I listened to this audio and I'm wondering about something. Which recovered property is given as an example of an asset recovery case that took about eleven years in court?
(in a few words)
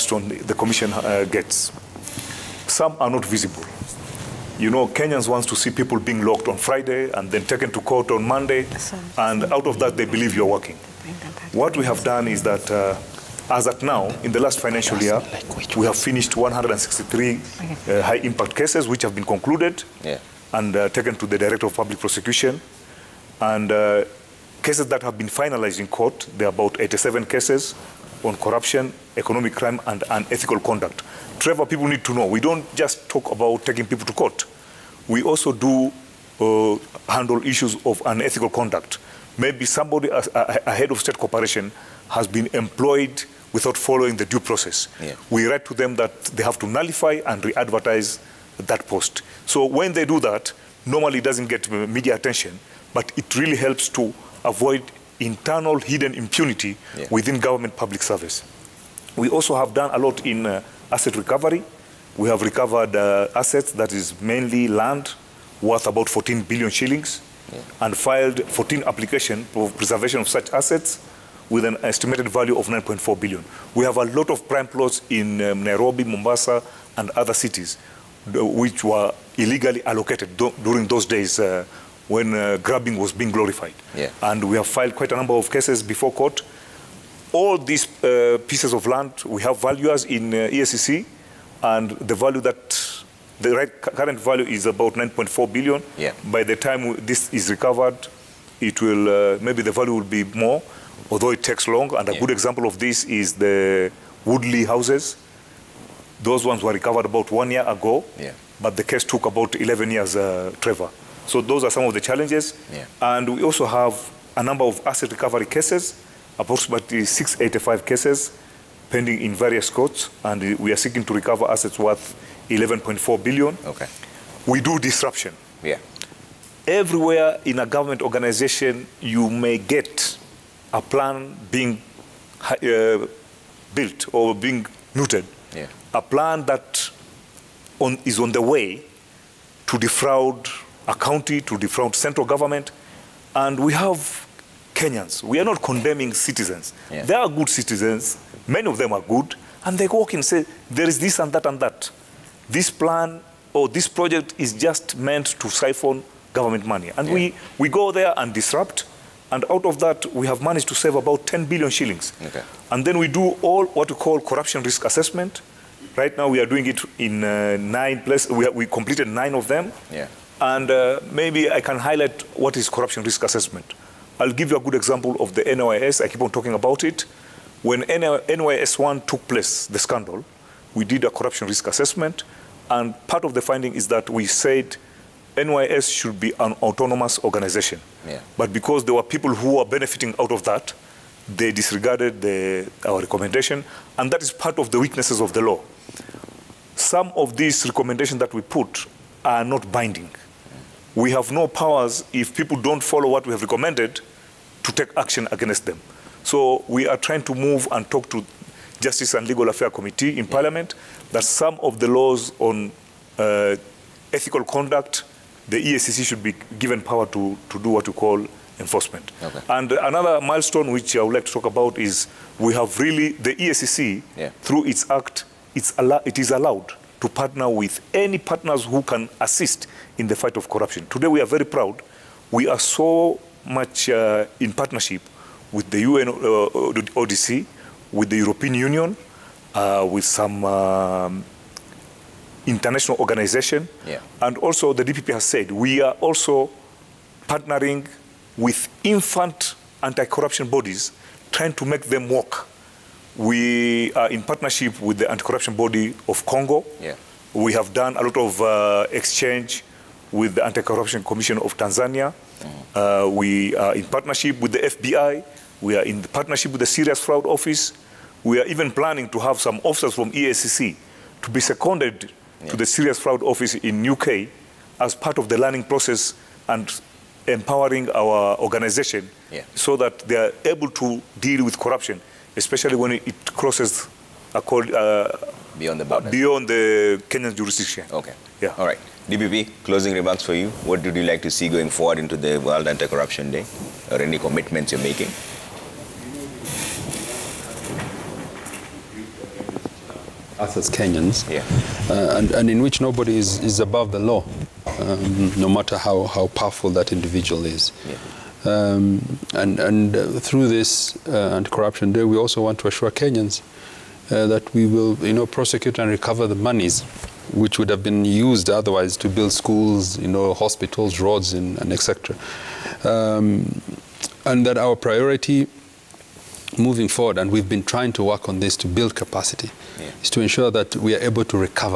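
Woodley houses.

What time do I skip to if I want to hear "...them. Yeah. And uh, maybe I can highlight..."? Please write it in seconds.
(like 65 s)
169 s.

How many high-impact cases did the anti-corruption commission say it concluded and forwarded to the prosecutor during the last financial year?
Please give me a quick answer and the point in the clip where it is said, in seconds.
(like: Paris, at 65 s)
163, at 16 s.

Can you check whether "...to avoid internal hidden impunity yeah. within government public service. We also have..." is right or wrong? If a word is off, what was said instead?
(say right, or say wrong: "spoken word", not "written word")
right.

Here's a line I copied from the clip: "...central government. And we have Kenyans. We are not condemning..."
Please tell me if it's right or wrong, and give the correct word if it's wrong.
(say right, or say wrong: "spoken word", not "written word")
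right.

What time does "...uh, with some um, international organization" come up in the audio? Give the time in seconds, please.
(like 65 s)
239 s.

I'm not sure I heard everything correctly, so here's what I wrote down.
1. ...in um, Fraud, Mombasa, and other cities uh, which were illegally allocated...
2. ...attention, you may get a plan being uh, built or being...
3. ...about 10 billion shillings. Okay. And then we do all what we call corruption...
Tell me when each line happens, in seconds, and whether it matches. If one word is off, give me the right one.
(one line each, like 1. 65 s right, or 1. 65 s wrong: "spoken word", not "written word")
1. 75 s wrong: "Nairobi", not "Fraud"
2. 128 s wrong: "organization", not "attention"
3. 160 s right.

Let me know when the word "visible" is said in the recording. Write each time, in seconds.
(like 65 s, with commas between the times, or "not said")
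3 s.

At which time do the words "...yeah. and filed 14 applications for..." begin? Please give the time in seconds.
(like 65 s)
67 s.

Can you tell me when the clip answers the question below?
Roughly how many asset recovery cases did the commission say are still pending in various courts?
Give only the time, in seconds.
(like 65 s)
117 s.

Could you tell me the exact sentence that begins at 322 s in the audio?
Um, and that our priority moving forward, and we've been trying to work on this to build capacity, yeah.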